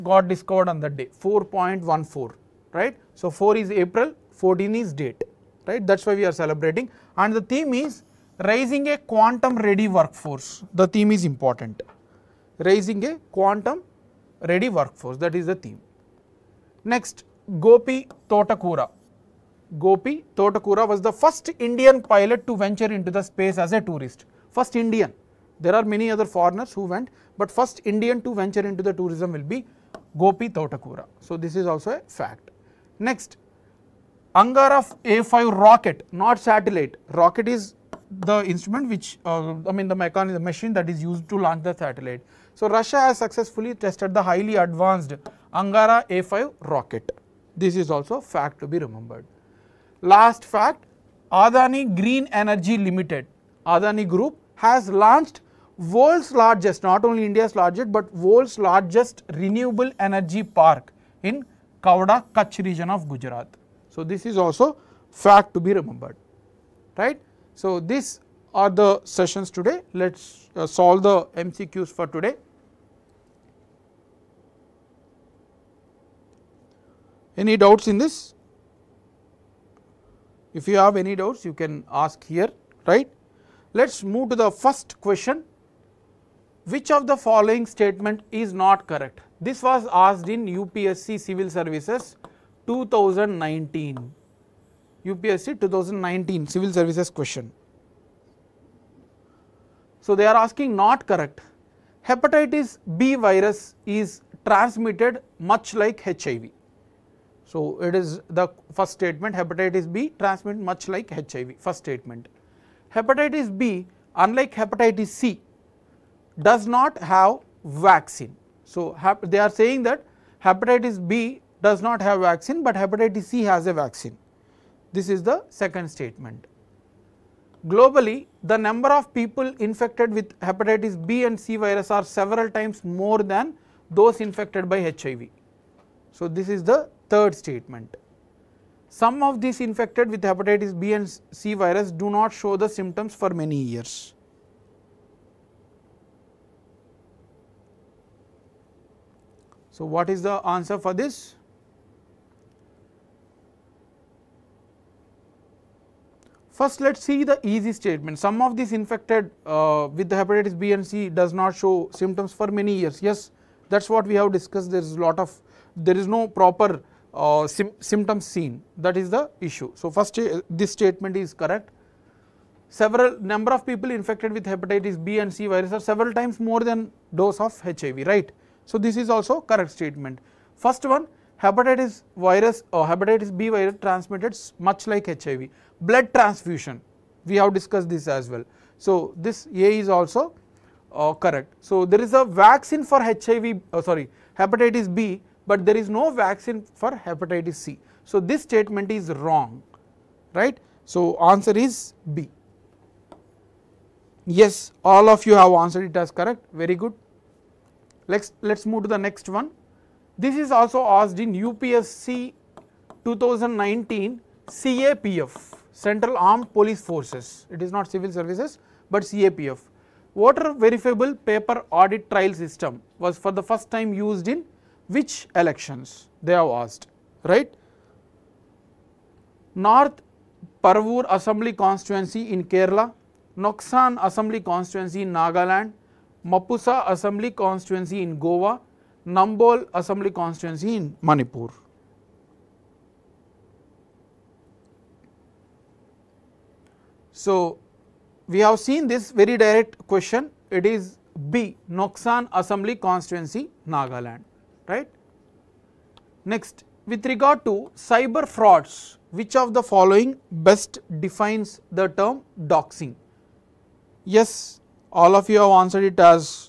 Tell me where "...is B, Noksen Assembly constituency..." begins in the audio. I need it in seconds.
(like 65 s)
250 s.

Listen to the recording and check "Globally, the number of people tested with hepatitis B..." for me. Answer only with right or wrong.
wrong.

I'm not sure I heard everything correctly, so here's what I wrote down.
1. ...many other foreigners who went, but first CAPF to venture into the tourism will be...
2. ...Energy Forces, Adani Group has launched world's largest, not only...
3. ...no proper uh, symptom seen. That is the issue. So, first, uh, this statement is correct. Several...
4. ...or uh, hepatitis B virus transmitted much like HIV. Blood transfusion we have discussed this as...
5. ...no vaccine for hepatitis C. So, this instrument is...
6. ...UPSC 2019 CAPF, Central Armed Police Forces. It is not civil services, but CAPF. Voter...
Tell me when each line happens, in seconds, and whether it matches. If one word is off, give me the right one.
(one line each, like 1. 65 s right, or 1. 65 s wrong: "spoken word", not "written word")
1. 25 s wrong: "Indian", not "CAPF"
2. 52 s wrong: "Limited", not "Forces"
3. 166 s right
4. 182 s right
5. 195 s wrong: "statement", not "instrument"
6. 211 s right.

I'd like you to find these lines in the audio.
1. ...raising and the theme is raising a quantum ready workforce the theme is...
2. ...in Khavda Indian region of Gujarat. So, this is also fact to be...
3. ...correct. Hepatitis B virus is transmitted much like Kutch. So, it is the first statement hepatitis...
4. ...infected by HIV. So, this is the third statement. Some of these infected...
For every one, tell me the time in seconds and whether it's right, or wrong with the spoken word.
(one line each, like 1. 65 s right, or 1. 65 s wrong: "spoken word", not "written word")
1. 6 s wrong: "celebrating", not "raising"
2. 61 s wrong: "Kutch", not "Indian"
3. 101 s wrong: "HIV", not "Kutch"
4. 134 s right.